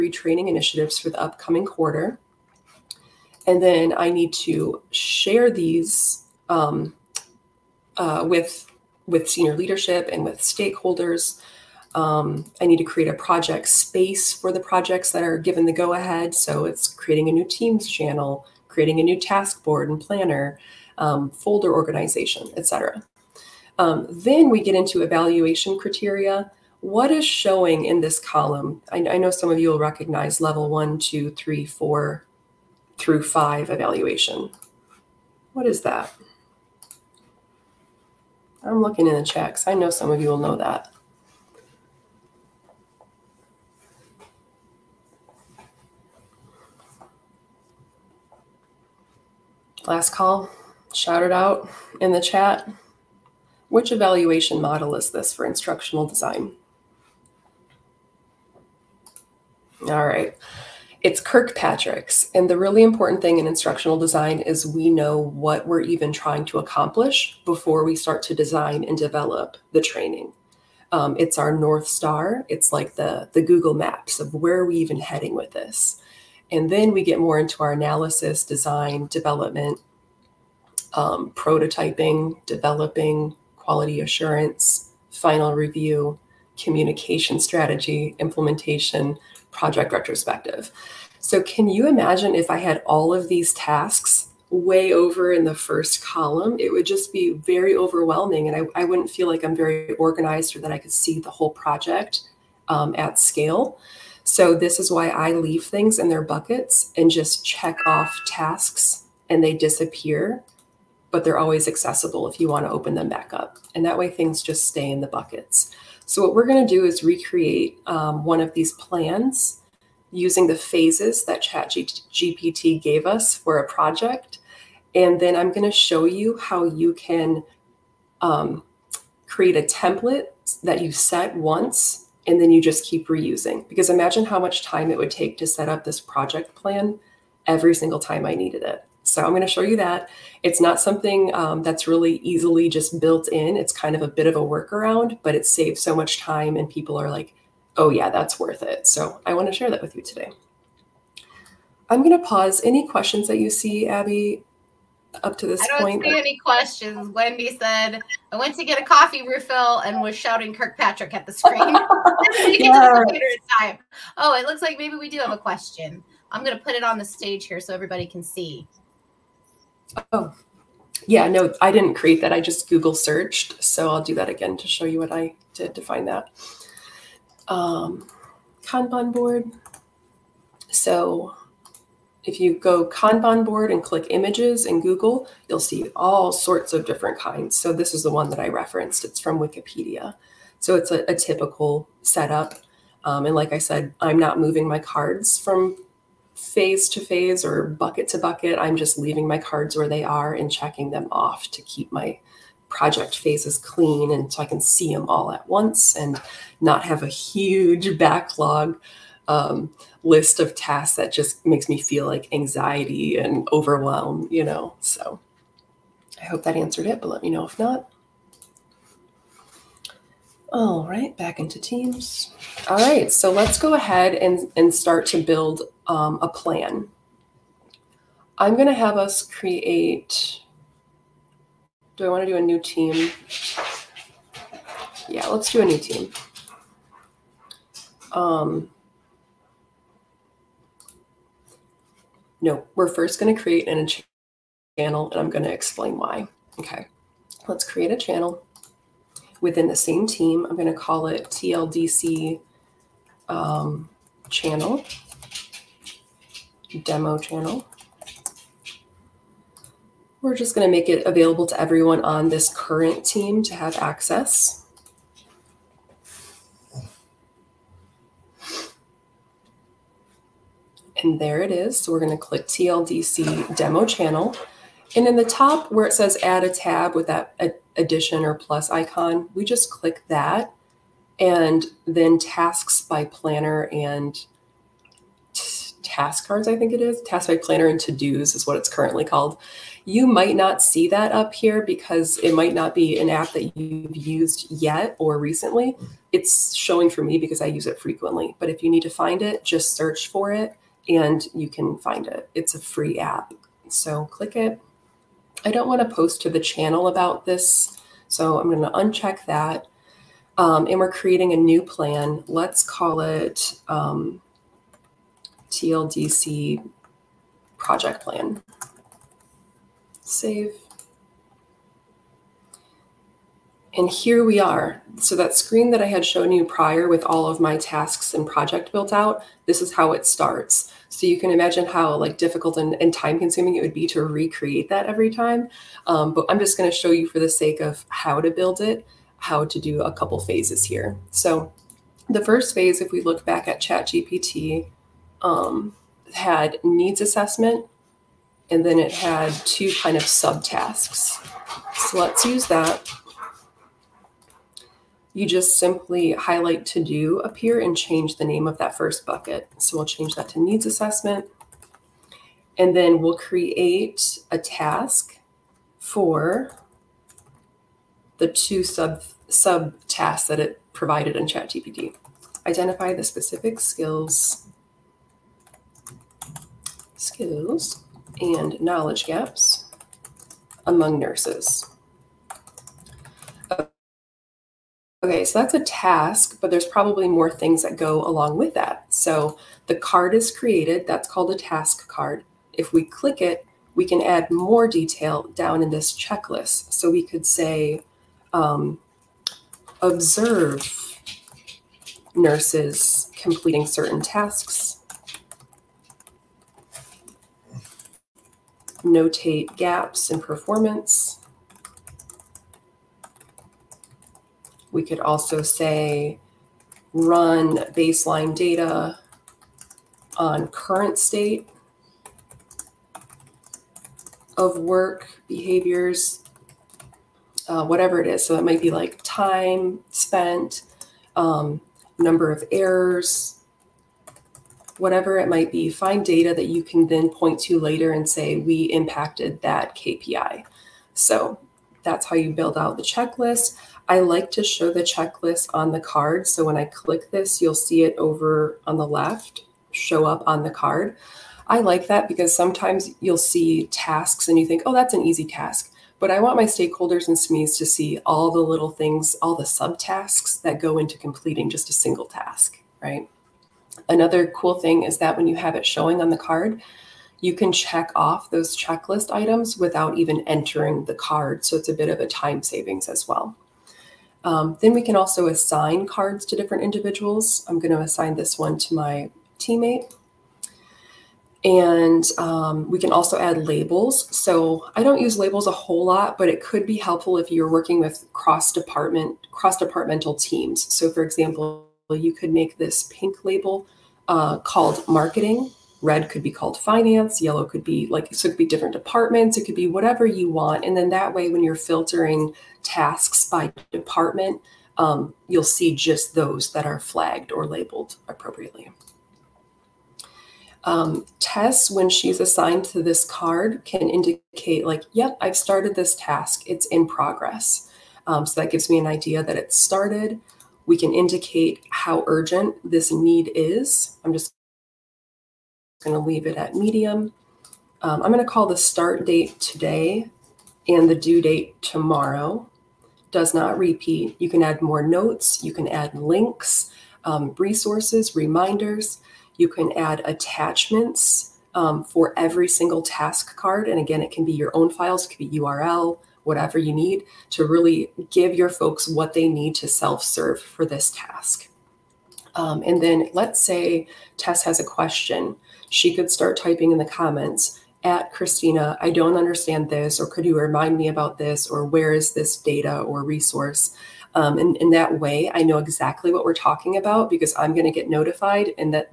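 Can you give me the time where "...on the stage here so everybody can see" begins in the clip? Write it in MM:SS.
02:46.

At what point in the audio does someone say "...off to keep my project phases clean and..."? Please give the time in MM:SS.
03:21.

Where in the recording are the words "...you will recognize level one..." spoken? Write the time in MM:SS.
00:29.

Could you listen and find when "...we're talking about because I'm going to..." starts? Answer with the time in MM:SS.
09:26.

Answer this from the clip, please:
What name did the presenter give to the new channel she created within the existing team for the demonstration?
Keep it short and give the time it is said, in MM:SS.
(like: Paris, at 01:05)
TLDC demo channel, at 04:32.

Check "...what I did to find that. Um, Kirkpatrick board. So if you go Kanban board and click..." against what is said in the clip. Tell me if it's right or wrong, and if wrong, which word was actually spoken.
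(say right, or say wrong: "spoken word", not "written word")
wrong: "Kanban", not "Kirkpatrick".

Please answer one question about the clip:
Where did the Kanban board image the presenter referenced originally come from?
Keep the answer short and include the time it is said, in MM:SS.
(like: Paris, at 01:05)
Wikipedia, at 03:09.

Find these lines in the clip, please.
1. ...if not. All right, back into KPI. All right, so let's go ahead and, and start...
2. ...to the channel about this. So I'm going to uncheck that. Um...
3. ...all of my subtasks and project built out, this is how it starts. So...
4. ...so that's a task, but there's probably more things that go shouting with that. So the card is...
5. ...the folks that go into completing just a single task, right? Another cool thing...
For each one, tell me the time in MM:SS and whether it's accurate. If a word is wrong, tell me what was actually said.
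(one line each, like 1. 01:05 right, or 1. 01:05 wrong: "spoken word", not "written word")
1. 03:37 wrong: "Teams", not "KPI"
2. 05:06 right
3. 05:27 wrong: "tasks", not "subtasks"
4. 06:25 wrong: "along", not "shouting"
5. 07:39 wrong: "subtasks", not "folks".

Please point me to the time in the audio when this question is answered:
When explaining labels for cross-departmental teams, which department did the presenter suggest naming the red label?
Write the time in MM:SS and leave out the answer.
08:16.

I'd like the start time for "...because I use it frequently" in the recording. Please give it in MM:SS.
04:57.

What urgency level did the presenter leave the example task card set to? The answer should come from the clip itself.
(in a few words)
medium.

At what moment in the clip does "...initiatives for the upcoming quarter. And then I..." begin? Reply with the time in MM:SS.
00:00.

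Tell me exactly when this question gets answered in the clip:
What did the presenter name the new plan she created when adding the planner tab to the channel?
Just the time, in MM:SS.
05:15.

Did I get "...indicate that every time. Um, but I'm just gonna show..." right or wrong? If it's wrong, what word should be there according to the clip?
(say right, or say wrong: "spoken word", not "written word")
wrong: "recreate", not "indicate".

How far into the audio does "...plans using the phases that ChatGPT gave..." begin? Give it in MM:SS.
01:58.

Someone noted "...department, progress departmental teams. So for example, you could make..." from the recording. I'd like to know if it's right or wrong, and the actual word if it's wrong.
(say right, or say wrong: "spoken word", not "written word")
wrong: "cross", not "progress".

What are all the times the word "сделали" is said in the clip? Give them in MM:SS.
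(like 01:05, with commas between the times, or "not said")
not said.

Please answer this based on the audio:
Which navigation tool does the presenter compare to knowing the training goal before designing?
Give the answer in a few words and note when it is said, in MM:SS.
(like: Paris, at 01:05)
Google Maps, at 01:13.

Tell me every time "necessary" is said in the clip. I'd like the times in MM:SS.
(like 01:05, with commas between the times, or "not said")
not said.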